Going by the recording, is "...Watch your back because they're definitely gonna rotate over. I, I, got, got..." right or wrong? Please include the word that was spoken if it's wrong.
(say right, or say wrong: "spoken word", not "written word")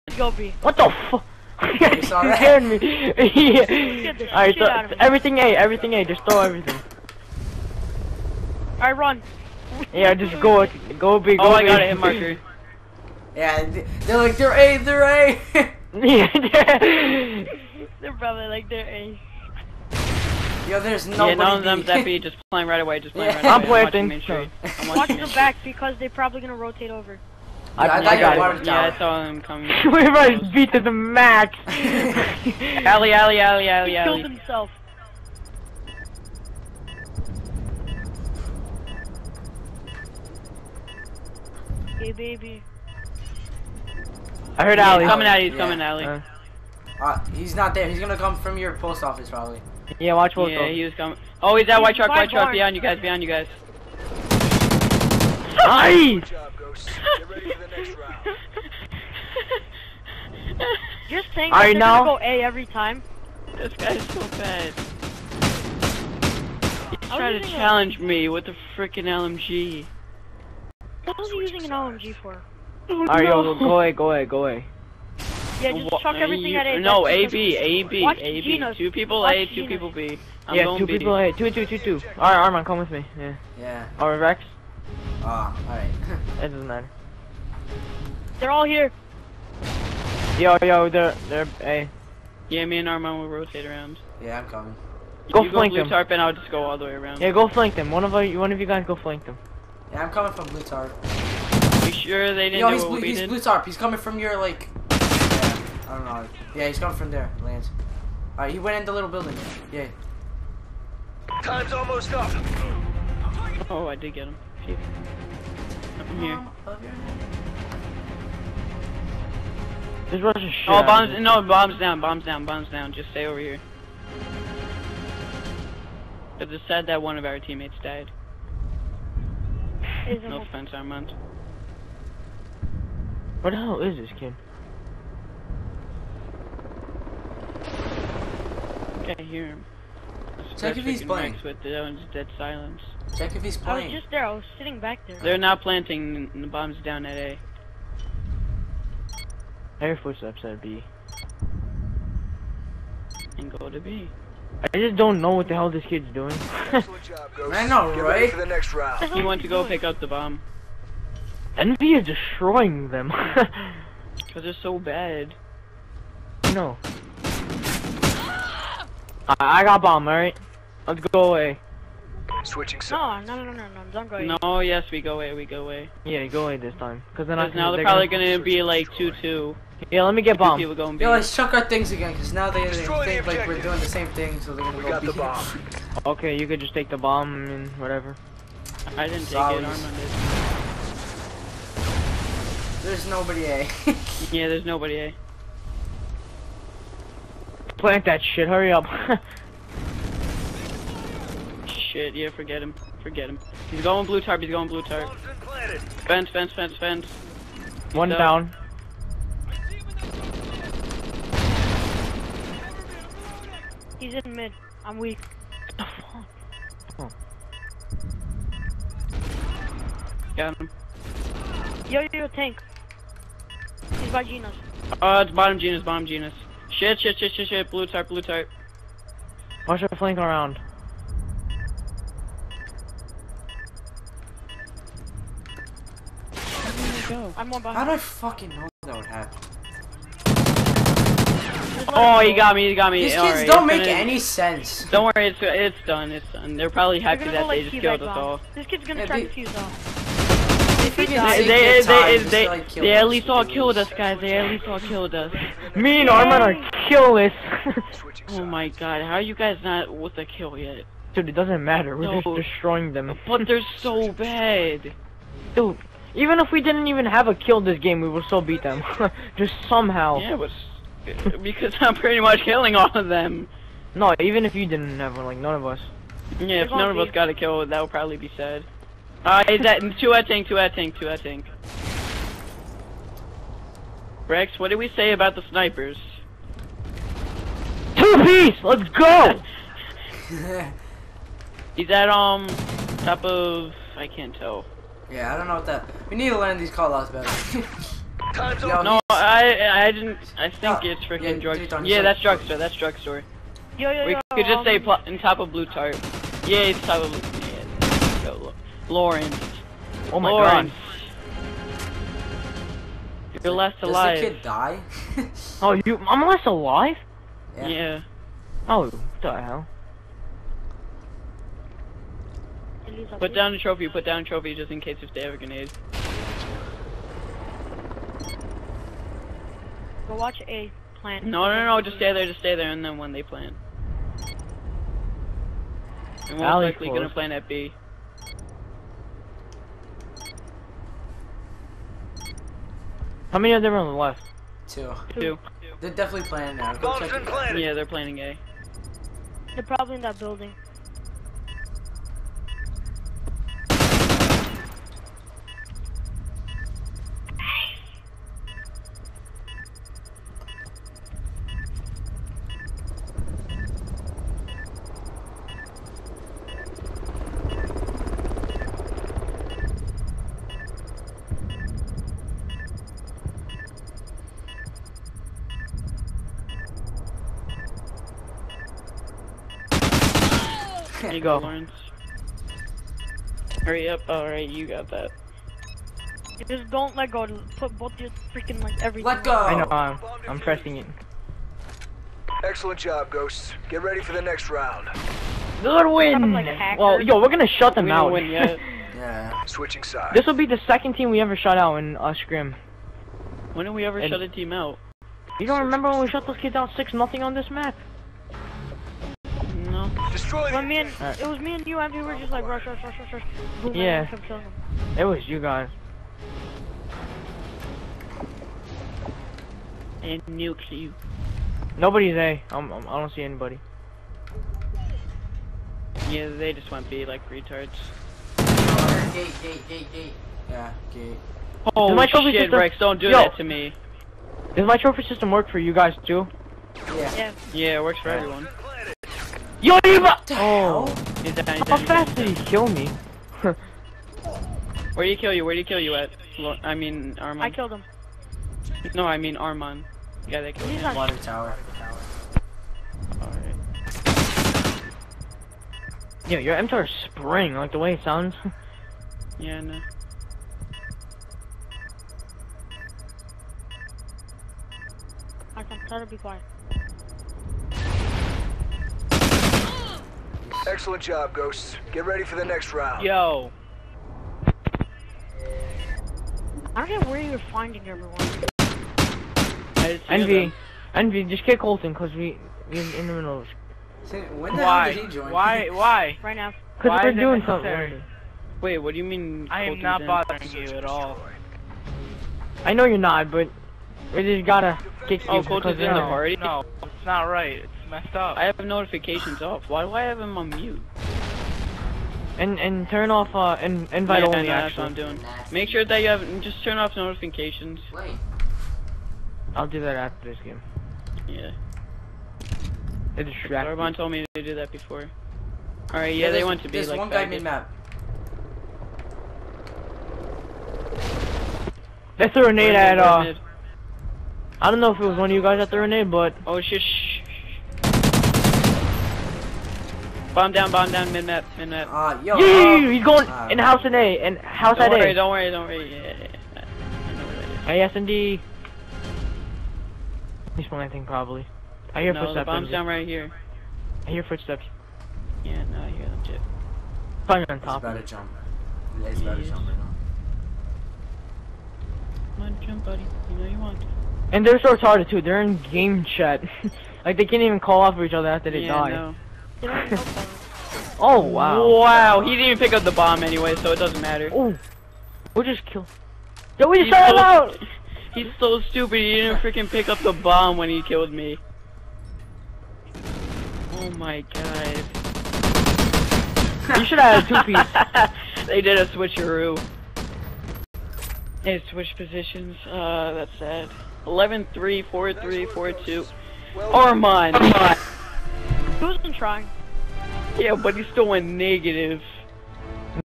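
wrong: "probably", not "definitely".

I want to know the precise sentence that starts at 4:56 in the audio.
We need to learn these call outs better.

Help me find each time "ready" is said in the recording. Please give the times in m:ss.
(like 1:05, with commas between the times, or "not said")
6:33, 7:52.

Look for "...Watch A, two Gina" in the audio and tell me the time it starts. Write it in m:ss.
1:19.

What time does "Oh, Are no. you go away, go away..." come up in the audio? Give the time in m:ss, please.
1:12.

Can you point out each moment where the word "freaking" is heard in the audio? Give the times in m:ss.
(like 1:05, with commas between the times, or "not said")
1:08, 5:01, 6:28, 9:29.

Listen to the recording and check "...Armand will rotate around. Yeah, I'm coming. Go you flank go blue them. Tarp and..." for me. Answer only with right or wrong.
right.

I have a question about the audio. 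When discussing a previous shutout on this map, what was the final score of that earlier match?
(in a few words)
6-0.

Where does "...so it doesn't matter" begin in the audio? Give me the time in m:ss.
9:23.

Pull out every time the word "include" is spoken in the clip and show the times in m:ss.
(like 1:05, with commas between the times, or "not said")
not said.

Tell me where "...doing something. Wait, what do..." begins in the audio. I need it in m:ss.
8:07.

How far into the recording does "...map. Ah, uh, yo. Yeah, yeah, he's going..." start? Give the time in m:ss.
8:51.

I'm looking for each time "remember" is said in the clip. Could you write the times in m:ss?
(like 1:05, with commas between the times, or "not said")
6:45.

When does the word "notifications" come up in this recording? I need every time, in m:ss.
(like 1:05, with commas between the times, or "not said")
8:18, 8:26.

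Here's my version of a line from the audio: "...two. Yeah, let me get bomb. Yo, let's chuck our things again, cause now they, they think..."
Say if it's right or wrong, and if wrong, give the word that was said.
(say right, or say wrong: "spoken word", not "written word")
right.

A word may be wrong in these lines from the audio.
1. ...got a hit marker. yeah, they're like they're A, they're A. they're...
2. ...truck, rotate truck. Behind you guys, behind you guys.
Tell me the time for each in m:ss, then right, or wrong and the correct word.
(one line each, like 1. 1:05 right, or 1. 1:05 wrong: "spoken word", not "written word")
1. 0:11 right
2. 0:51 wrong: "white", not "rotate".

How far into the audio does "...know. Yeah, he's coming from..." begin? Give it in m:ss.
1:46.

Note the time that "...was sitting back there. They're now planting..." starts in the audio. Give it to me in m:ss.
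2:24.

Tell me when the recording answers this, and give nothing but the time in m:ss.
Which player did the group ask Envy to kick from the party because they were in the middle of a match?
8:01.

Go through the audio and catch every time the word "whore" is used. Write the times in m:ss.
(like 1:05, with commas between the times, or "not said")
not said.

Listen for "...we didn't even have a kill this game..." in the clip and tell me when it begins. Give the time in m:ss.
4:26.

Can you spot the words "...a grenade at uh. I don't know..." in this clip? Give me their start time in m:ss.
8:42.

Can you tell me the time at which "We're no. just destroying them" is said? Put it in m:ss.
4:21.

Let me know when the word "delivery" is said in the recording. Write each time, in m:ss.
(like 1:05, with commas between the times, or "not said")
not said.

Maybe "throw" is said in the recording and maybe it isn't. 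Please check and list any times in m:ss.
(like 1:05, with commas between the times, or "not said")
0:06, 9:26.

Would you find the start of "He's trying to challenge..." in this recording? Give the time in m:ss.
1:06.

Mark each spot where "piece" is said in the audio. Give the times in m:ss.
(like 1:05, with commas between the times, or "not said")
4:48, 9:38.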